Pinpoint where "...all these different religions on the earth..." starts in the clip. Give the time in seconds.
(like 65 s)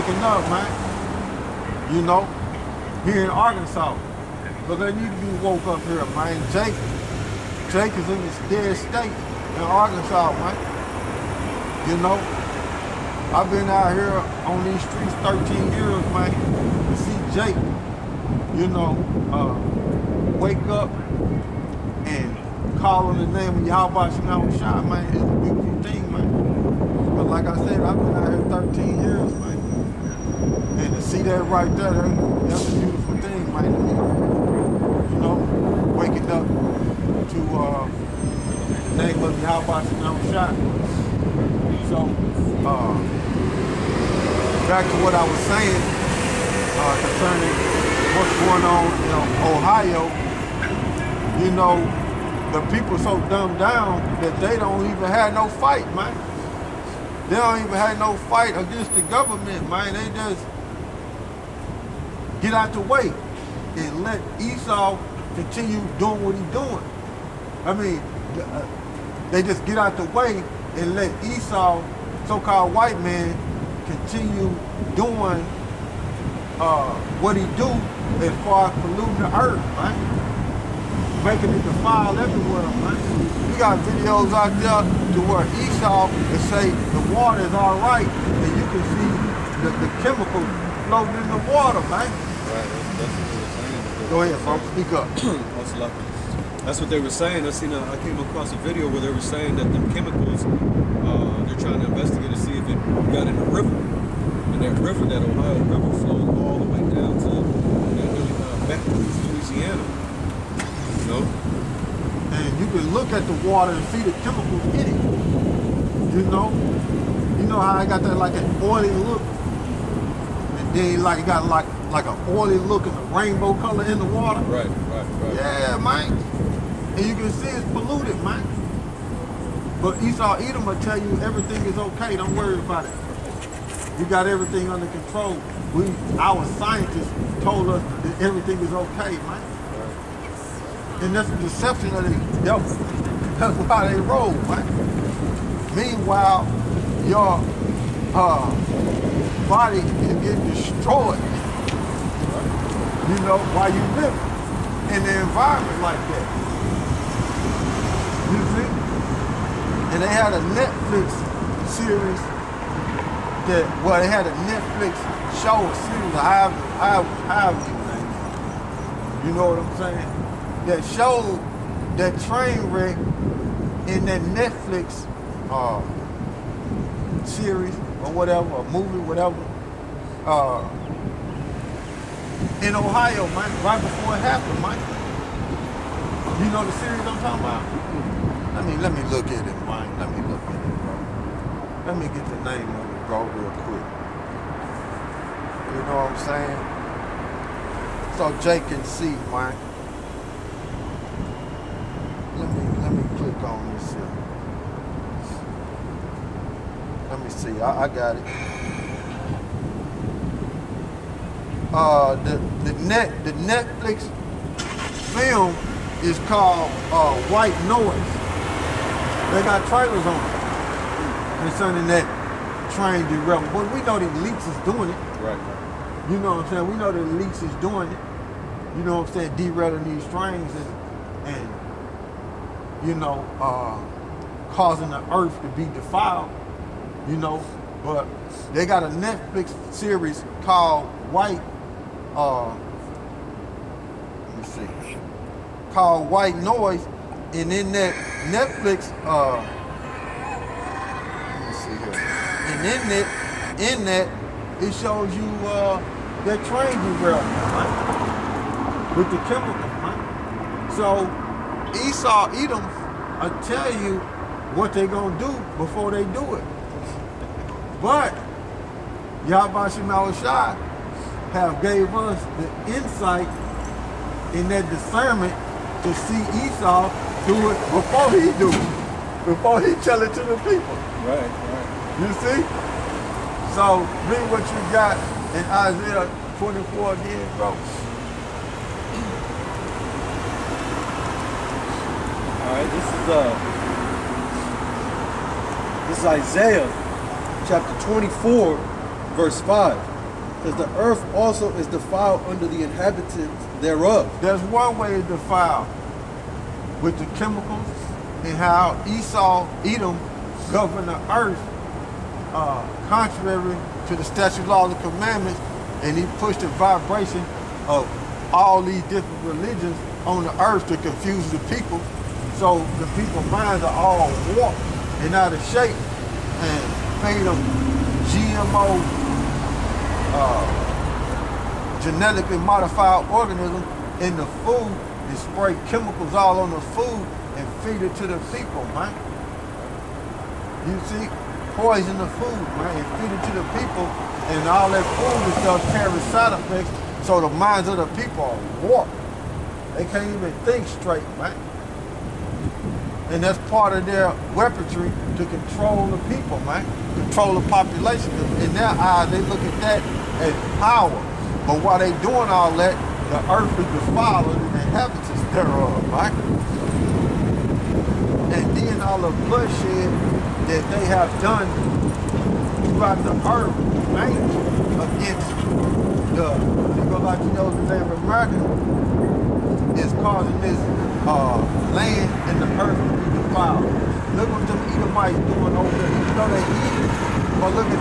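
318 s.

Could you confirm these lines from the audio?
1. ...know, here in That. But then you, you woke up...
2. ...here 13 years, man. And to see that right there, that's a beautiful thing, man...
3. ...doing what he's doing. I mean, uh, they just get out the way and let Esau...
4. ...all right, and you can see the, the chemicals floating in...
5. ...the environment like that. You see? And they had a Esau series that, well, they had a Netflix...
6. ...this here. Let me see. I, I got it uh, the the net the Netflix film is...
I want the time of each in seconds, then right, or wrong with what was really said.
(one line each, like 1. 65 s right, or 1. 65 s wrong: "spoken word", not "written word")
1. 2 s wrong: "Arkansas", not "That"
2. 28 s right
3. 65 s right
4. 87 s right
5. 155 s wrong: "Netflix", not "Esau"
6. 203 s right.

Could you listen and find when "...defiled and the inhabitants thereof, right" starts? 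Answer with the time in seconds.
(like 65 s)
363 s.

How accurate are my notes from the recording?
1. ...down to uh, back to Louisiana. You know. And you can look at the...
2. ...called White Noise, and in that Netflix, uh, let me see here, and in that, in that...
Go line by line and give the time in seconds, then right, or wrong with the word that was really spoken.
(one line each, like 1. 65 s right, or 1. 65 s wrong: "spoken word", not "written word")
1. 106 s right
2. 245 s right.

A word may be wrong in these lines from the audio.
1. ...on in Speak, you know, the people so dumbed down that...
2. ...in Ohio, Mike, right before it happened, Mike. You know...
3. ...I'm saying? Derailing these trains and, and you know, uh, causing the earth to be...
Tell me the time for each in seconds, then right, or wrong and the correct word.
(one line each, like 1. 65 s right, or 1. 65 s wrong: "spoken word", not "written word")
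1. 48 s wrong: "Ohio", not "Speak"
2. 182 s right
3. 229 s right.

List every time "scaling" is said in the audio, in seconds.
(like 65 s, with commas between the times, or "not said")
not said.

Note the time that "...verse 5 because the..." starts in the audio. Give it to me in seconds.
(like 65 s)
299 s.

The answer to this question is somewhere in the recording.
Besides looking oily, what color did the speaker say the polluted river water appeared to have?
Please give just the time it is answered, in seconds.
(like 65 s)
123 s.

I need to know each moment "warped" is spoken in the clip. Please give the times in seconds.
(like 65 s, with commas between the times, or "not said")
324 s, 348 s.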